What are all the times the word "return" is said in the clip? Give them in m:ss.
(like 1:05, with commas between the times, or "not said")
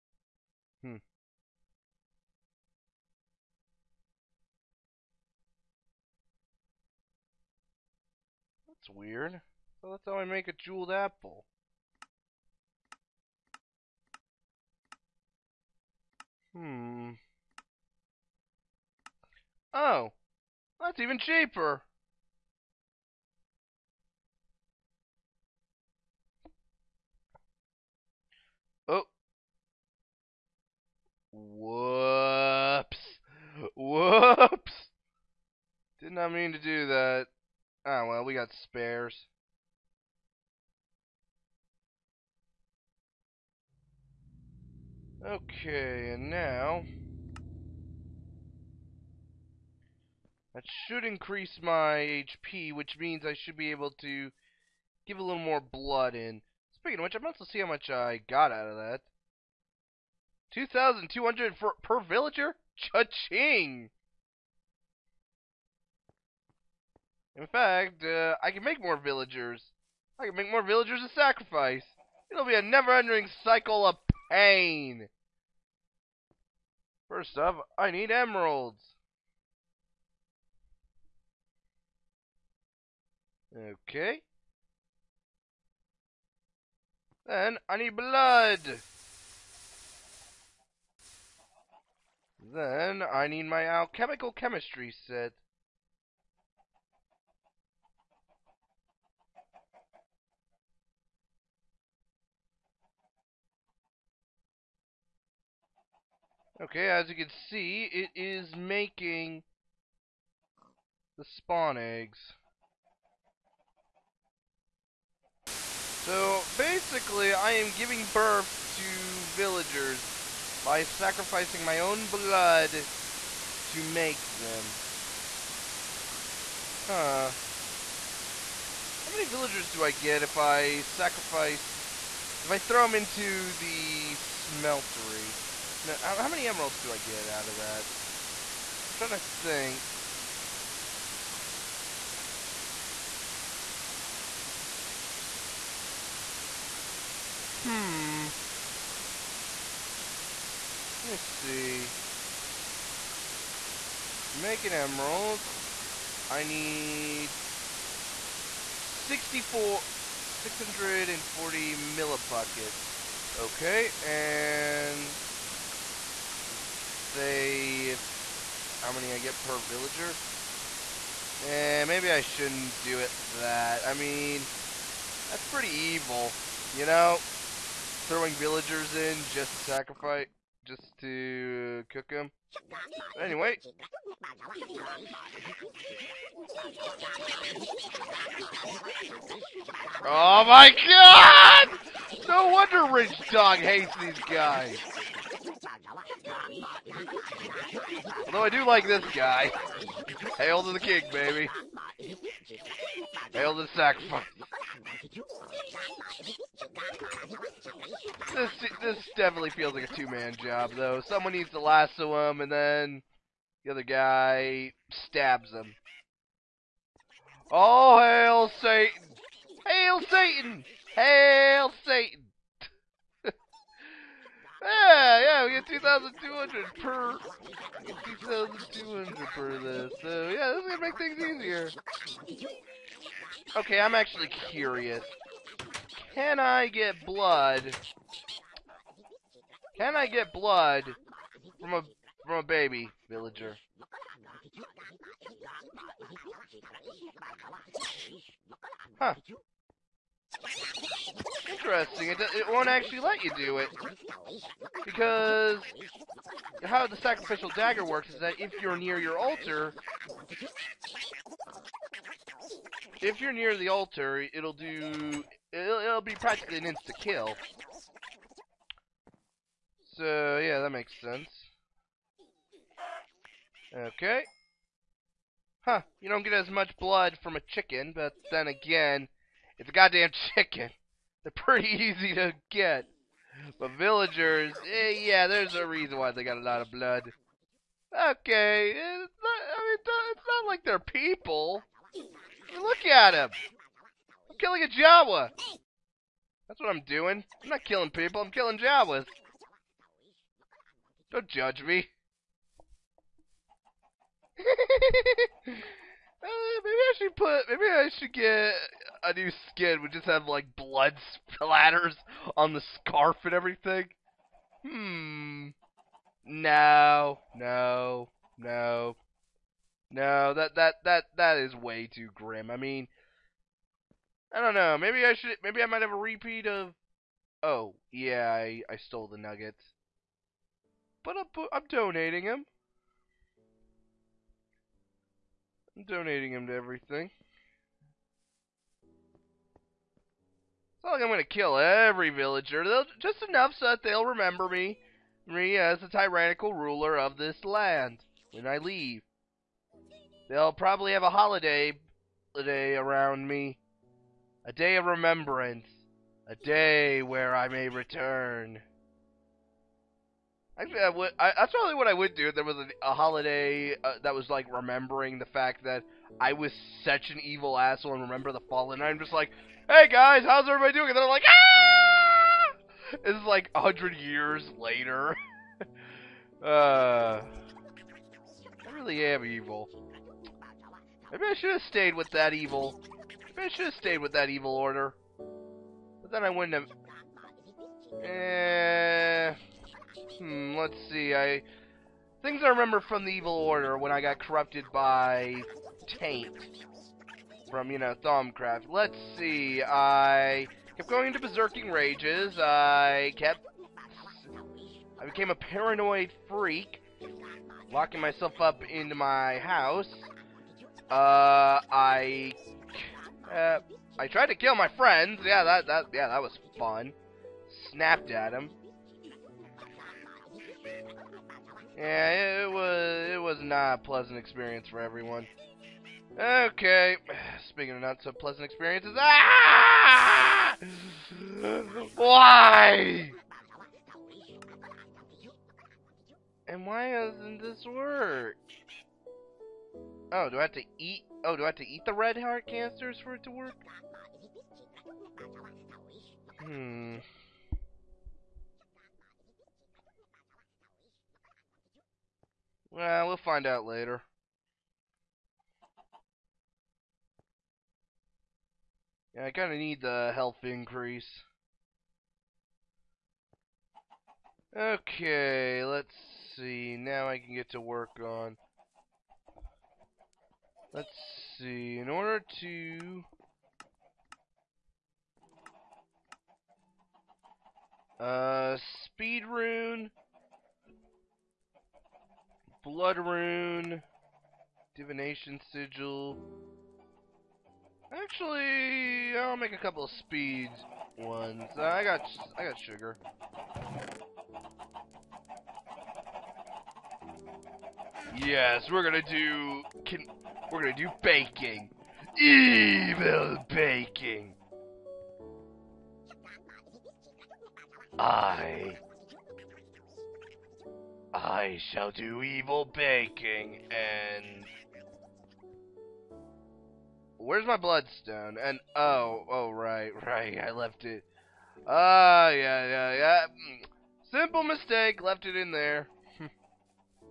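5:57.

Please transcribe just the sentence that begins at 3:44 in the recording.
Yeah, yeah, we get 2,200 per, 2,200 per this.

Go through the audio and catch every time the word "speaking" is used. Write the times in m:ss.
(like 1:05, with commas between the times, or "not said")
0:56, 7:07.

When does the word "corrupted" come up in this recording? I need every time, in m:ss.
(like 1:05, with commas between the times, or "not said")
6:34.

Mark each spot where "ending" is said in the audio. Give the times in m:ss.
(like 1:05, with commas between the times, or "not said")
1:12.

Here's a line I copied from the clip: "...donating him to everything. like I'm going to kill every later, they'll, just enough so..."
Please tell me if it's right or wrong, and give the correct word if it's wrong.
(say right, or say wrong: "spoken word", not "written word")
wrong: "villager", not "later".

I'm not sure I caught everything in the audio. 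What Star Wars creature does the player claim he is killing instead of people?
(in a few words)
Jawa.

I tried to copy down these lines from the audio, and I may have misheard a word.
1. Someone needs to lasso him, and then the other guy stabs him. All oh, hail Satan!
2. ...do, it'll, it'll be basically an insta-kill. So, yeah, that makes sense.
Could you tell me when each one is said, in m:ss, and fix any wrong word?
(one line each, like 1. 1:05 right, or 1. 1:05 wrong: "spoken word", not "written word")
1. 3:31 right
2. 4:24 wrong: "practically", not "basically".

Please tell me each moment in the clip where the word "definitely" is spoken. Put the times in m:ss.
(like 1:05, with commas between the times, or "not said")
3:29.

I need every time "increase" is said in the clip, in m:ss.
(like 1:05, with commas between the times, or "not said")
0:51, 7:40.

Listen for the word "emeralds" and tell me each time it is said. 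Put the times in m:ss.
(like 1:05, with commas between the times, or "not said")
1:18, 2:16, 2:34.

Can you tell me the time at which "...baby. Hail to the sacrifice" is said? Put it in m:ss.
3:21.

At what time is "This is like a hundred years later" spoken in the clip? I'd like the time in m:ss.
6:13.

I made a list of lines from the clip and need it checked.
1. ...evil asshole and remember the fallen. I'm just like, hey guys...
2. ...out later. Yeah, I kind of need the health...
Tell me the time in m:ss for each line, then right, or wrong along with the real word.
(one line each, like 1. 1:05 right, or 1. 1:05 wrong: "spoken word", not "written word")
1. 6:07 right
2. 7:33 right.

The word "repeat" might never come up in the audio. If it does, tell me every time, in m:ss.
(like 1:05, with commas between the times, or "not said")
5:25.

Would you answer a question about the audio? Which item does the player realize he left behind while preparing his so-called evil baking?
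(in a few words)
bloodstone.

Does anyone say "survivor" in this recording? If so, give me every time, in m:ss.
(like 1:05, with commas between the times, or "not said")
not said.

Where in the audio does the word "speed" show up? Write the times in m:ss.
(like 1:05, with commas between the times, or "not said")
7:58, 8:10.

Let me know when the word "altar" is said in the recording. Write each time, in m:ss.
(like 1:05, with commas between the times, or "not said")
4:19, 4:23.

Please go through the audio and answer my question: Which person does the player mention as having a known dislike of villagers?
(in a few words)
Rich Dog.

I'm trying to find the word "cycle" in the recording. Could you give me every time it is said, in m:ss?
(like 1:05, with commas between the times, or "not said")
1:13.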